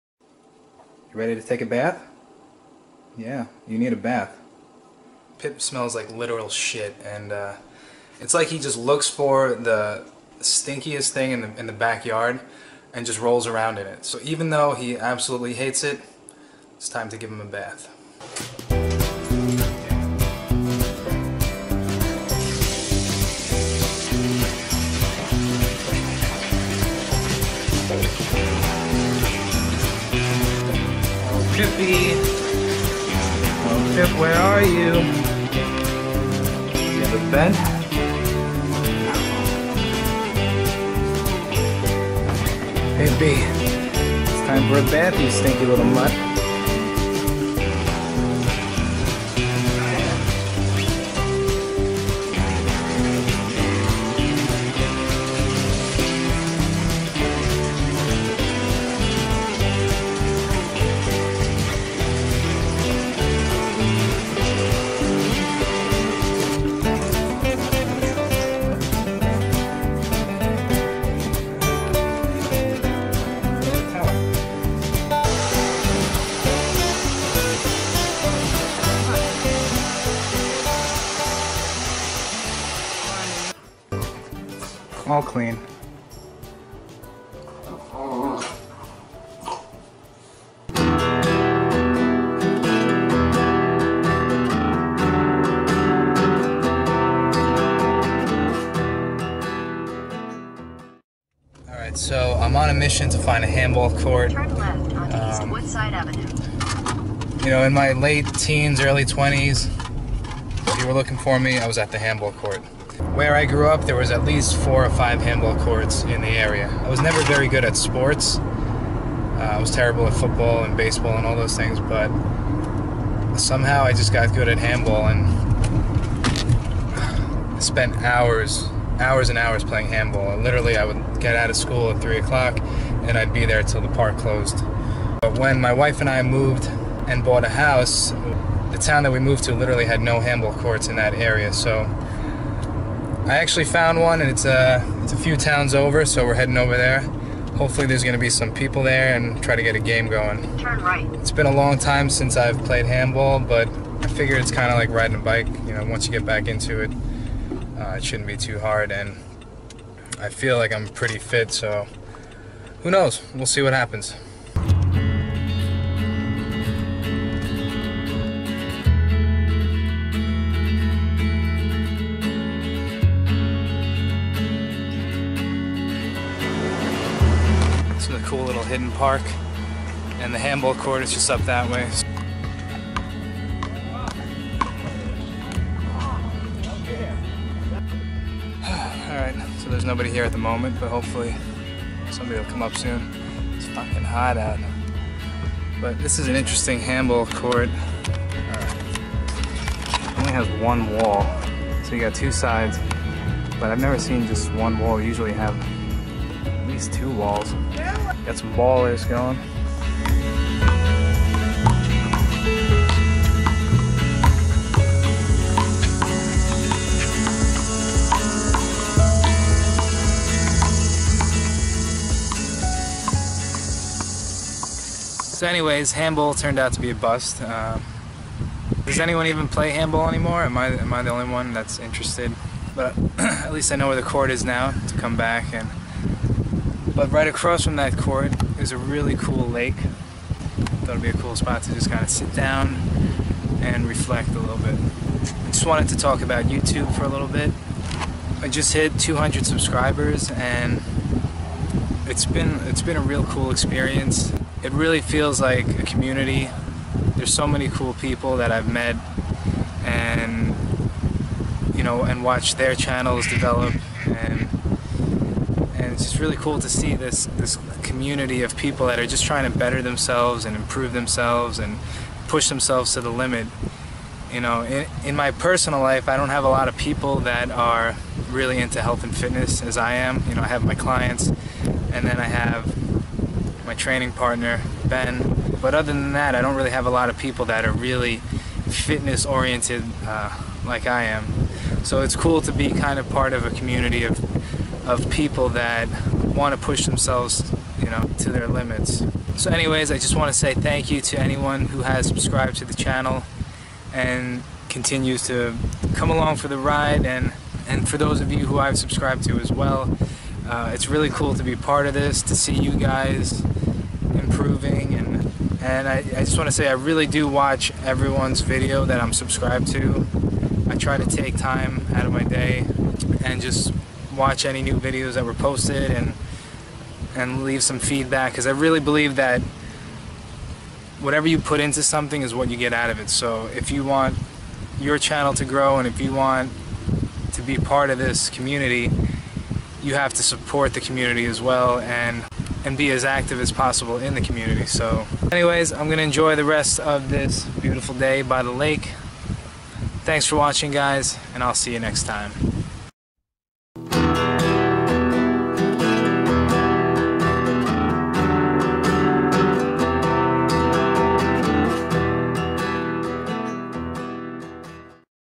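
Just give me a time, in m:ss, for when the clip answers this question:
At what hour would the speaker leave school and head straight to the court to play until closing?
2:12.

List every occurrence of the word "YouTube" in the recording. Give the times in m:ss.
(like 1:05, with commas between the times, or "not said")
4:06.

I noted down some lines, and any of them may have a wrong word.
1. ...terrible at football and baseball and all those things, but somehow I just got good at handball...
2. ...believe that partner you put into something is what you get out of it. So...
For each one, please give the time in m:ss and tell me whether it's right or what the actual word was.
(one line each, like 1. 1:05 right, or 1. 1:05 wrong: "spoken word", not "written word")
1. 1:59 right
2. 5:28 wrong: "whatever", not "partner".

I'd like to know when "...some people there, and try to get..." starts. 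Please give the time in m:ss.
2:28.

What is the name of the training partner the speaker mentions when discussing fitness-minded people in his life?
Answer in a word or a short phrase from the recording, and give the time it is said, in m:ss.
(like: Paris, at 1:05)
Ben, at 4:44.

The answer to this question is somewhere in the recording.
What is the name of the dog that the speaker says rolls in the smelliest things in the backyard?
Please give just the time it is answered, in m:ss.
0:05.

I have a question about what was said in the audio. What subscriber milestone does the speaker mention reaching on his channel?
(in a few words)
200.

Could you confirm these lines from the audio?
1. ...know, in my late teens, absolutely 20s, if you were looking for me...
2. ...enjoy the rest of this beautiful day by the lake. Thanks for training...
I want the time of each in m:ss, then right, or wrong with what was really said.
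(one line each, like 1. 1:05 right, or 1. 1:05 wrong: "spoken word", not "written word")
1. 1:47 wrong: "early", not "absolutely"
2. 5:46 wrong: "watching", not "training".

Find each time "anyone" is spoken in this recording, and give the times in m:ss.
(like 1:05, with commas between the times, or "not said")
3:48, 5:01.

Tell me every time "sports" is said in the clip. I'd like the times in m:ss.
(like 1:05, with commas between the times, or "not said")
1:57.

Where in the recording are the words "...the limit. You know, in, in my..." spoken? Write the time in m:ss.
4:33.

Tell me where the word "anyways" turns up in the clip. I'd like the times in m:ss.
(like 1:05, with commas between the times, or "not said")
3:45, 4:59, 5:45.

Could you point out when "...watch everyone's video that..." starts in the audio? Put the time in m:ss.
5:17.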